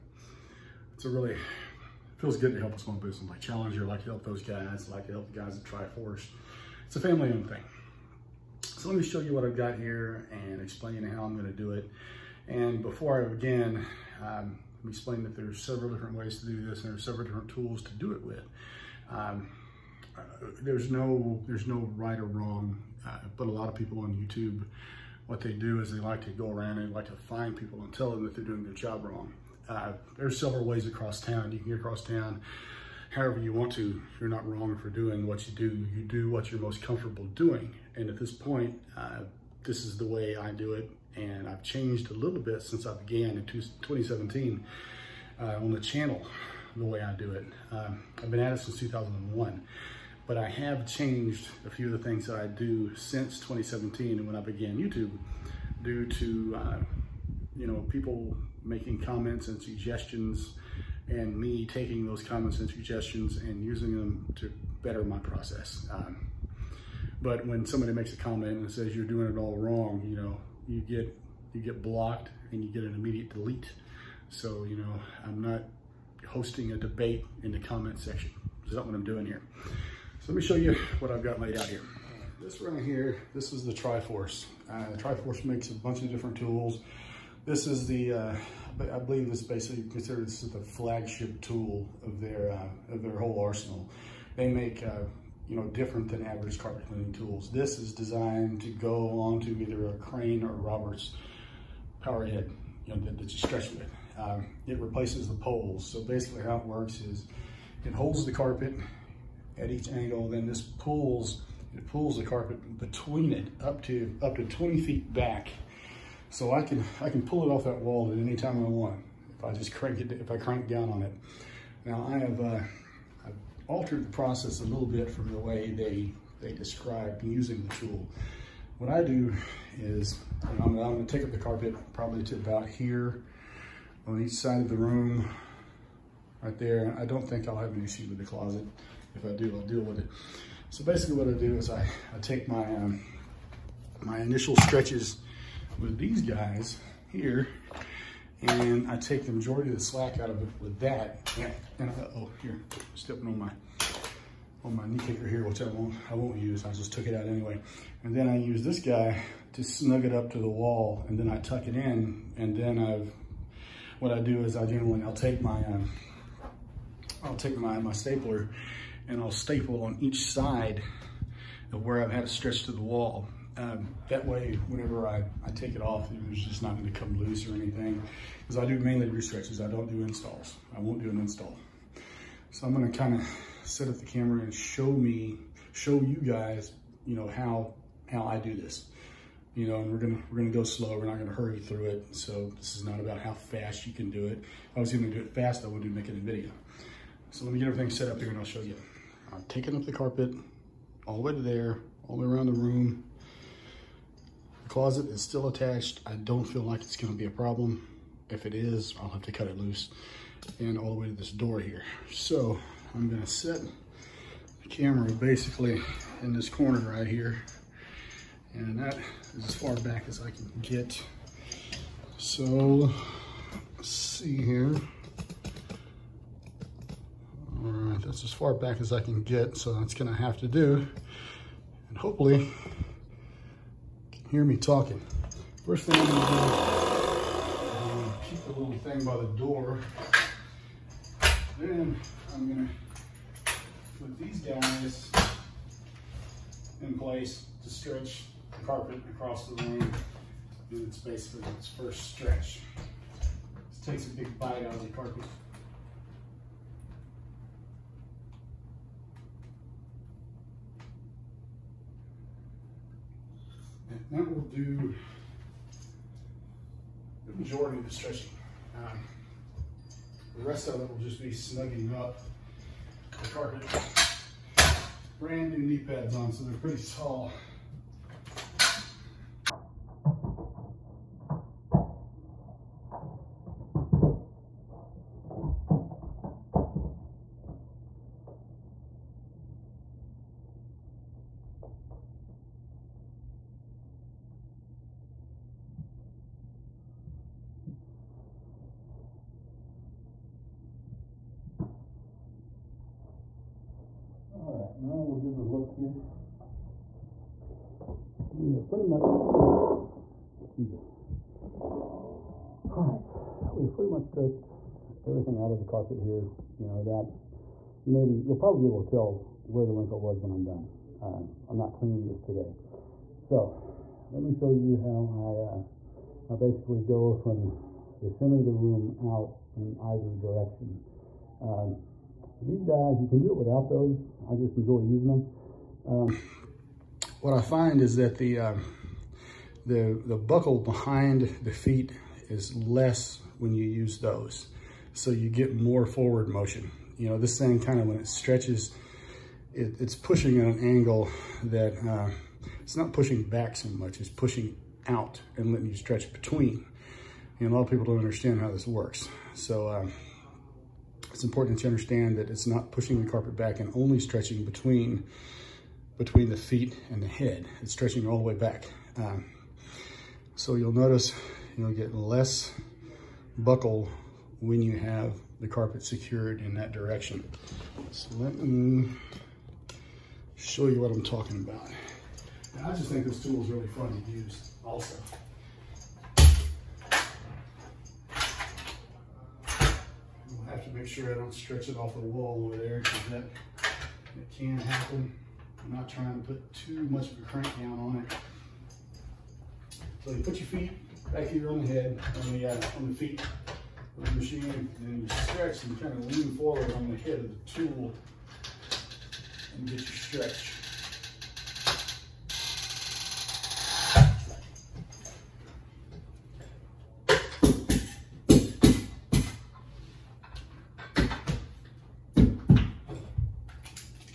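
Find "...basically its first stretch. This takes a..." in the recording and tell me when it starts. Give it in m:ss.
4:10.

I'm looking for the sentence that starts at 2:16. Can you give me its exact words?
I don't think I'll have an issue with the closet if I do, I'll deal with it.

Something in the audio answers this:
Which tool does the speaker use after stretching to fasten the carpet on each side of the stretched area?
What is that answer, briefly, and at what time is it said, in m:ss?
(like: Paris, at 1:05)
stapler, at 2:47.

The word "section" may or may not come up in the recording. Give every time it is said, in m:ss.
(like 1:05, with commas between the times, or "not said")
1:17.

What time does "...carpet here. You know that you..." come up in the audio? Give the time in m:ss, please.
5:15.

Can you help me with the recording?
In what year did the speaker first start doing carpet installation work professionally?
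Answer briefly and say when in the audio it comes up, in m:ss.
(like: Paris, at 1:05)
2001, at 0:48.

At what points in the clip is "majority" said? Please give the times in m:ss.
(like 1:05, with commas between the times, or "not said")
2:29, 4:27.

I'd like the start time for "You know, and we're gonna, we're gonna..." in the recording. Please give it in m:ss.
3:09.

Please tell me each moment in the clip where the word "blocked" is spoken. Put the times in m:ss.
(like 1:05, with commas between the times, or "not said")
1:11.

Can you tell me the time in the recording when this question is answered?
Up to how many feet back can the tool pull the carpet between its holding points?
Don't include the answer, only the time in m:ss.
1:54.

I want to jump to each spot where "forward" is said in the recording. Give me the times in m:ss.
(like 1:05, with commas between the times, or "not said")
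5:45, 6:46.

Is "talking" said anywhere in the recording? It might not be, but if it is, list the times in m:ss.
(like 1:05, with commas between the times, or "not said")
3:54, 6:21.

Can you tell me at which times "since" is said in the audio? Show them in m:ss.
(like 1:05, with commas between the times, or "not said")
0:42, 0:48, 0:52.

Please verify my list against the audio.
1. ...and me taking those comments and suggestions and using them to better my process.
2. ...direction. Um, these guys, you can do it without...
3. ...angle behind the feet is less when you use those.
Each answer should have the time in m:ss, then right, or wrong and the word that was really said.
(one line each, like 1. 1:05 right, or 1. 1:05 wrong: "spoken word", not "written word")
1. 1:01 right
2. 5:30 right
3. 5:40 wrong: "buckle", not "angle".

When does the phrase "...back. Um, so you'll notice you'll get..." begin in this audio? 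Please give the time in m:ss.
6:08.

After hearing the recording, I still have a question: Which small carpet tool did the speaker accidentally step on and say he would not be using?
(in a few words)
knee kicker.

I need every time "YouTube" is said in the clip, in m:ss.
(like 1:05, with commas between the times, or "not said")
0:24, 0:54.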